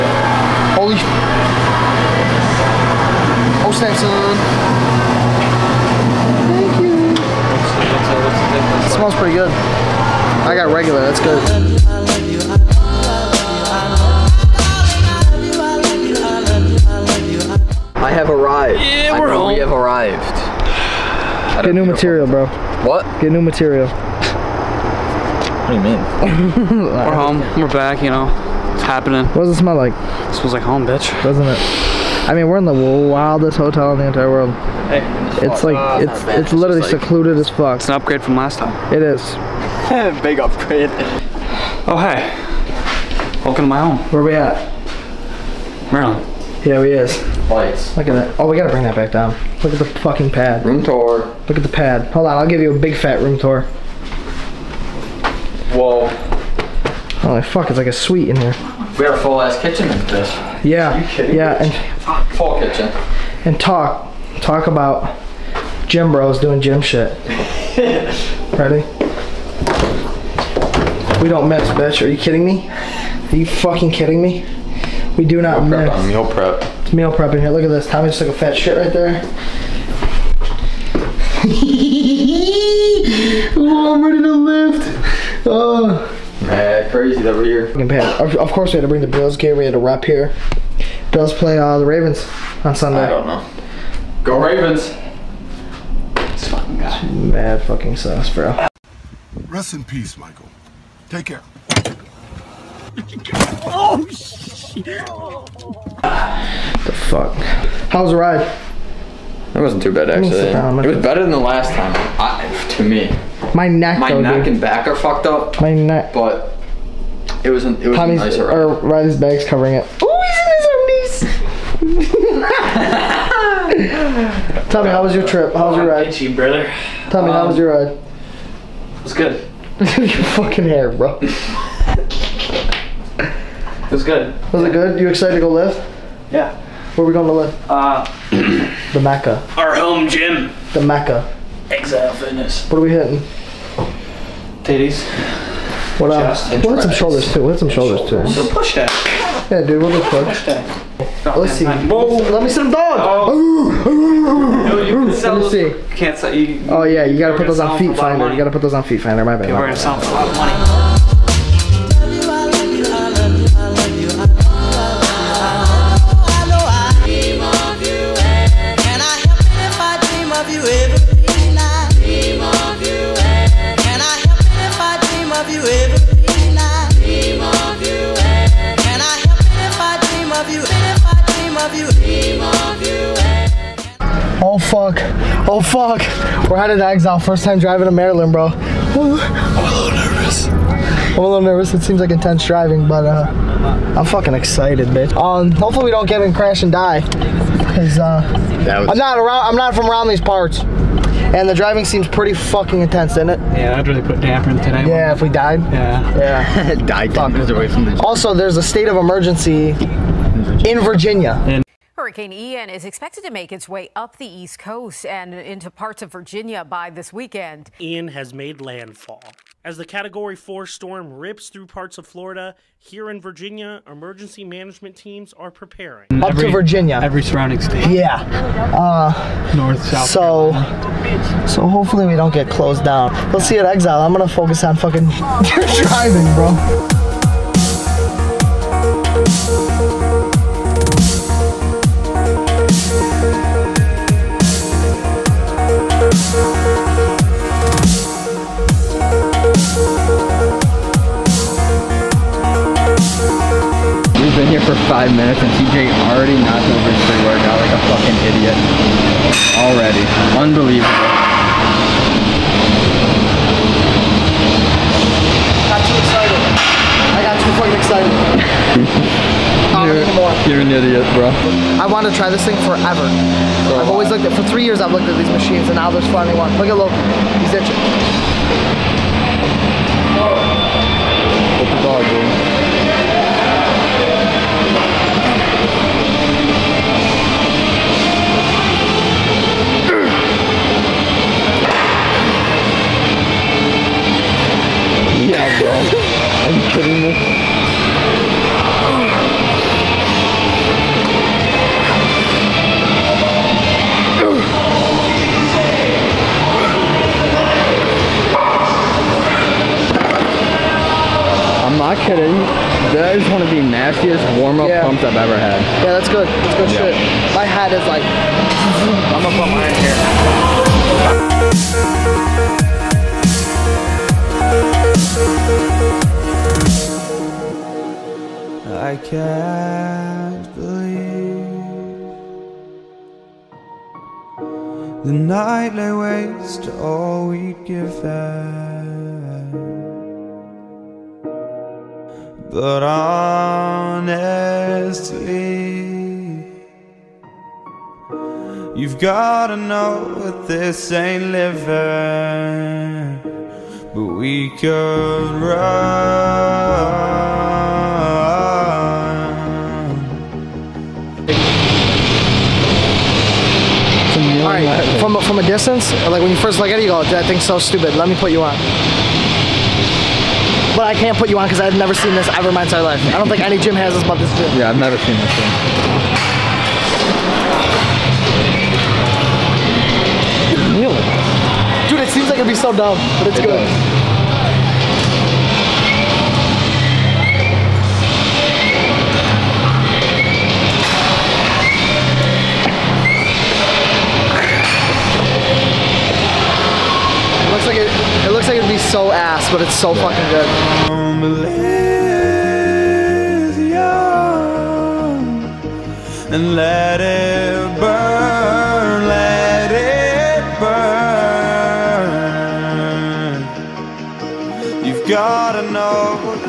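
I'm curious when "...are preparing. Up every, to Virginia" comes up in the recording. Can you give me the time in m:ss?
3:45.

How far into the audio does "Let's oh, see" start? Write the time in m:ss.
2:30.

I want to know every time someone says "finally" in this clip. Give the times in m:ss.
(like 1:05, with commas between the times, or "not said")
4:36.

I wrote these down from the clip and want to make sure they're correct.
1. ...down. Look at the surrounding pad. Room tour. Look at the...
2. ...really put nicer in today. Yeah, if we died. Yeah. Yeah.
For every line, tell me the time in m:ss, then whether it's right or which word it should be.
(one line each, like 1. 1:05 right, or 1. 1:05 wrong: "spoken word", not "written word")
1. 0:49 wrong: "fucking", not "surrounding"
2. 3:23 wrong: "damper", not "nicer".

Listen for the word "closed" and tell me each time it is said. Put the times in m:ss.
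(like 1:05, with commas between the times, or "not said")
3:52.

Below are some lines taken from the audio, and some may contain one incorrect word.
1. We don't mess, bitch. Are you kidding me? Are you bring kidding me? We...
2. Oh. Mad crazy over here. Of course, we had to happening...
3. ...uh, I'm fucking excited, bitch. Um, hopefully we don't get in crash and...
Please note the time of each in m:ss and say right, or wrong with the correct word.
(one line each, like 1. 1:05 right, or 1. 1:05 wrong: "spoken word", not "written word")
1. 1:11 wrong: "fucking", not "bring"
2. 1:25 wrong: "bring", not "happening"
3. 3:13 right.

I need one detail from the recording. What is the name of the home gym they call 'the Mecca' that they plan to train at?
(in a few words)
Exile Fitness.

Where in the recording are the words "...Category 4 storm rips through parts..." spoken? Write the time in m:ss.
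3:39.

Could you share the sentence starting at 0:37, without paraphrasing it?
It's an upgrade from last time.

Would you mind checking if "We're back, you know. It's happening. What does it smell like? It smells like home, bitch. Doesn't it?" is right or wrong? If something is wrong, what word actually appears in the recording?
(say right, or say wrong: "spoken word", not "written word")
right.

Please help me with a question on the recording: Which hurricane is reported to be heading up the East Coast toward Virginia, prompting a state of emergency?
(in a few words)
Hurricane Ian.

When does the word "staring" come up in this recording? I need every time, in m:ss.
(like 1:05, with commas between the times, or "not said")
not said.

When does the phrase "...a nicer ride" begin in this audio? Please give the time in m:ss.
1:57.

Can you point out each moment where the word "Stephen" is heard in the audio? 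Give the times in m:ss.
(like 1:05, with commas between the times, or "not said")
not said.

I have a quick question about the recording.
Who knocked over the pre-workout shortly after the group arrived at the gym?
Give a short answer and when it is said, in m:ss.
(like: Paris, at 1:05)
TJ, at 4:15.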